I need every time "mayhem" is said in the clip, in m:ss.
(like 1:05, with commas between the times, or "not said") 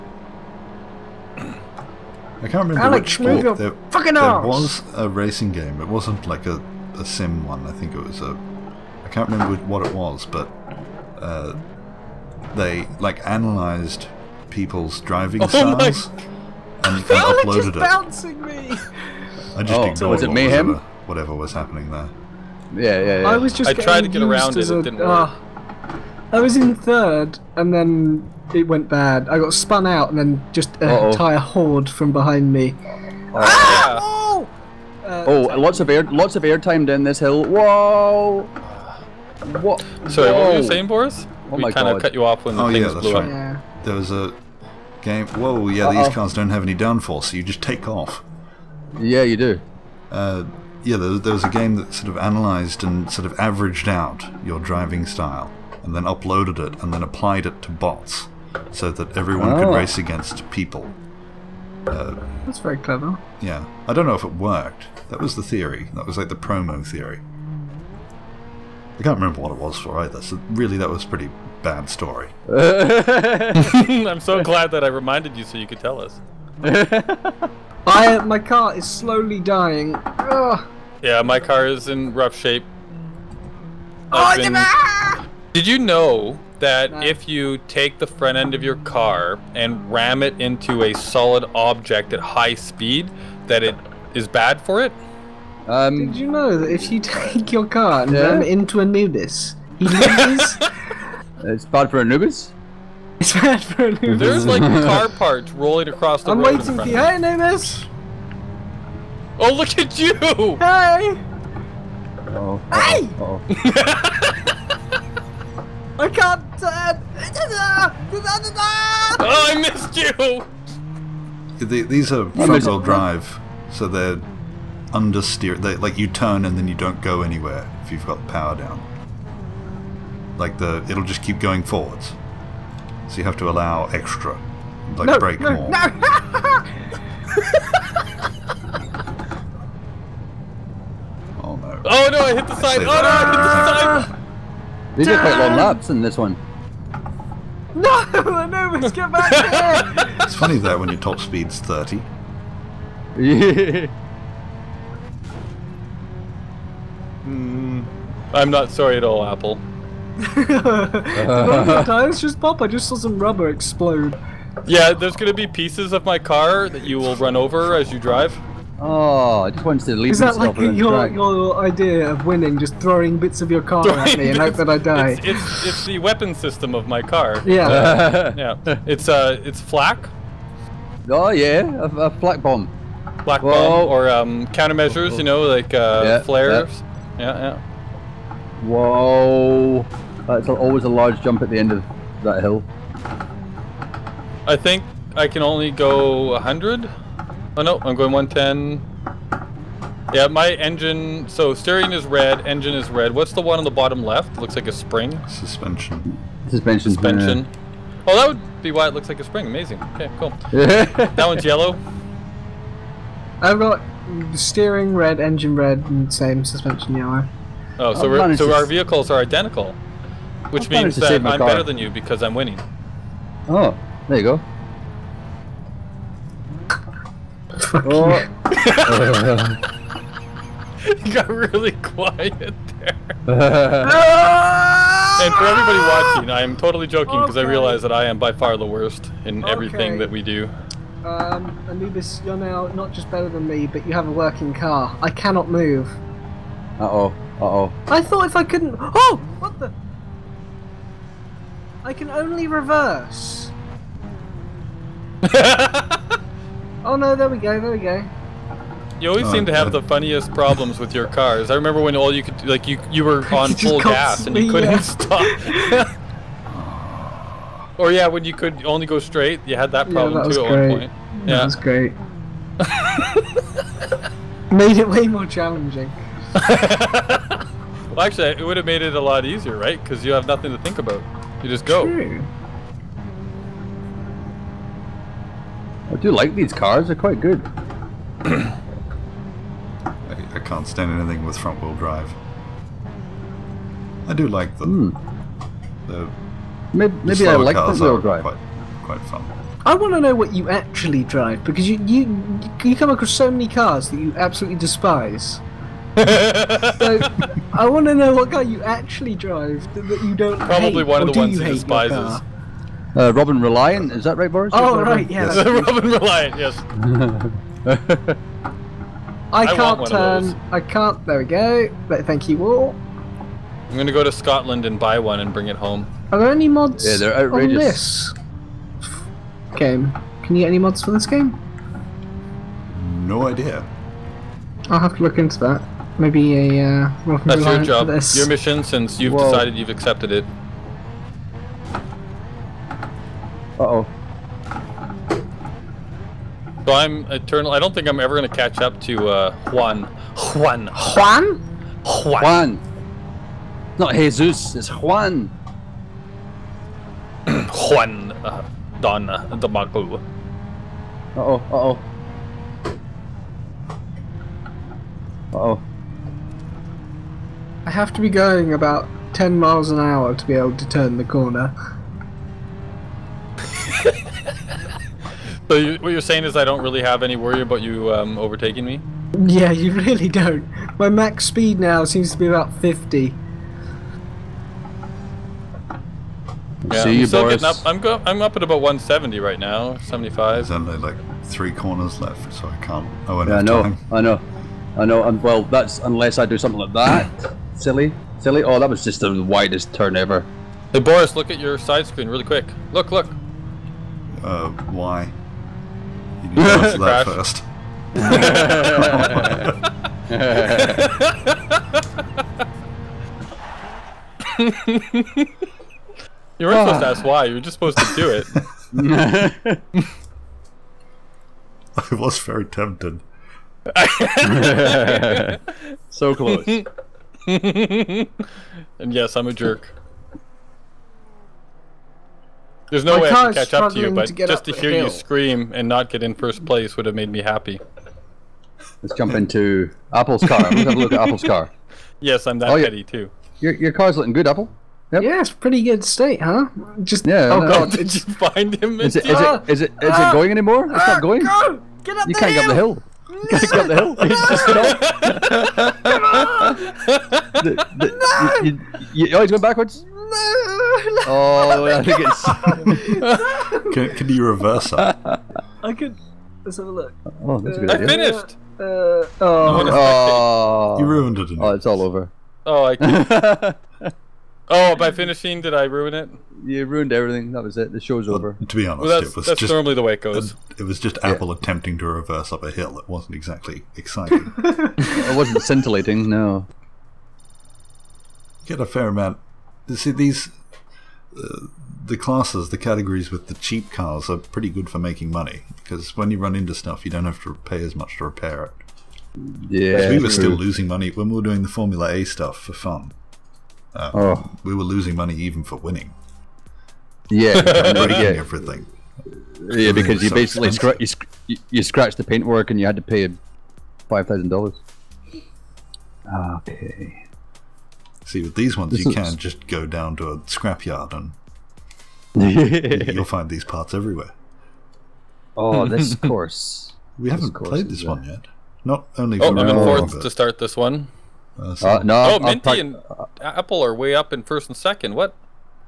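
0:20.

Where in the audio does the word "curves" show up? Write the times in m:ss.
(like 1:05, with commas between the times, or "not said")
not said.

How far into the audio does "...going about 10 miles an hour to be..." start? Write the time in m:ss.
6:08.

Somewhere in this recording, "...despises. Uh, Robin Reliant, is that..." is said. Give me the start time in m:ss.
5:11.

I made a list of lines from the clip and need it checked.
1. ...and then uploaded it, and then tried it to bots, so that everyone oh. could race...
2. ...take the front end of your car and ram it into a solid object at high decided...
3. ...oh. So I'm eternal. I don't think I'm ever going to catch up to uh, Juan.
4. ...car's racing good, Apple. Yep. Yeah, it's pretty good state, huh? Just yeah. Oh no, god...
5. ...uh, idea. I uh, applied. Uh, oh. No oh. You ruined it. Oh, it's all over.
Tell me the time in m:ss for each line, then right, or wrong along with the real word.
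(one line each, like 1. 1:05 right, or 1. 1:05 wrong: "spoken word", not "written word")
1. 0:55 wrong: "applied", not "tried"
2. 1:27 wrong: "speed", not "decided"
3. 5:43 right
4. 7:23 wrong: "looking", not "racing"
5. 7:47 wrong: "finished", not "applied".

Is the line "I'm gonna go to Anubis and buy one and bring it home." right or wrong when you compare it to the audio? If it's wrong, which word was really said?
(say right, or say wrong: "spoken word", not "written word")
wrong: "Scotland", not "Anubis".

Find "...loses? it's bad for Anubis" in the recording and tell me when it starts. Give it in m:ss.
1:39.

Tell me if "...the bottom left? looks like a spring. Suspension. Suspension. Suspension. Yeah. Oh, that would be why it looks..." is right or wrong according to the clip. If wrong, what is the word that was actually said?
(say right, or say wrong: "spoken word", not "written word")
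right.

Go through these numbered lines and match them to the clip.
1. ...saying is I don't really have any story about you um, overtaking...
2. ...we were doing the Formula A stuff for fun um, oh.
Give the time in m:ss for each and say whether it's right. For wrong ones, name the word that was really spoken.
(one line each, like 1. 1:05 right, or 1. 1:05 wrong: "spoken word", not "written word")
1. 6:15 wrong: "worry", not "story"
2. 8:21 right.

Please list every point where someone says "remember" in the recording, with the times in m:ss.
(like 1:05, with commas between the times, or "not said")
0:02, 0:09, 1:09, 4:21.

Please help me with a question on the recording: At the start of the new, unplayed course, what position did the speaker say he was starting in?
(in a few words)
fourth.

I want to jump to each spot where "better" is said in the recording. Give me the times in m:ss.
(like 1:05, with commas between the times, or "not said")
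3:41, 4:03.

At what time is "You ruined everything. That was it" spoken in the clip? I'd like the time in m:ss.
7:56.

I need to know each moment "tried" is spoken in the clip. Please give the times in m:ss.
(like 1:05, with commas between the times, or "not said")
0:23.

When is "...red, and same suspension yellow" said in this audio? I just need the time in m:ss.
3:35.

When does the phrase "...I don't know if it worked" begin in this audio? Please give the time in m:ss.
1:03.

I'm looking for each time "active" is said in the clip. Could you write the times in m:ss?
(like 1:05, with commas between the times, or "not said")
not said.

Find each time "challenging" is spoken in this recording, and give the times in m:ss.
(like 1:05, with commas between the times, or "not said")
4:35.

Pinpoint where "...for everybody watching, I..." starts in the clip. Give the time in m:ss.
3:55.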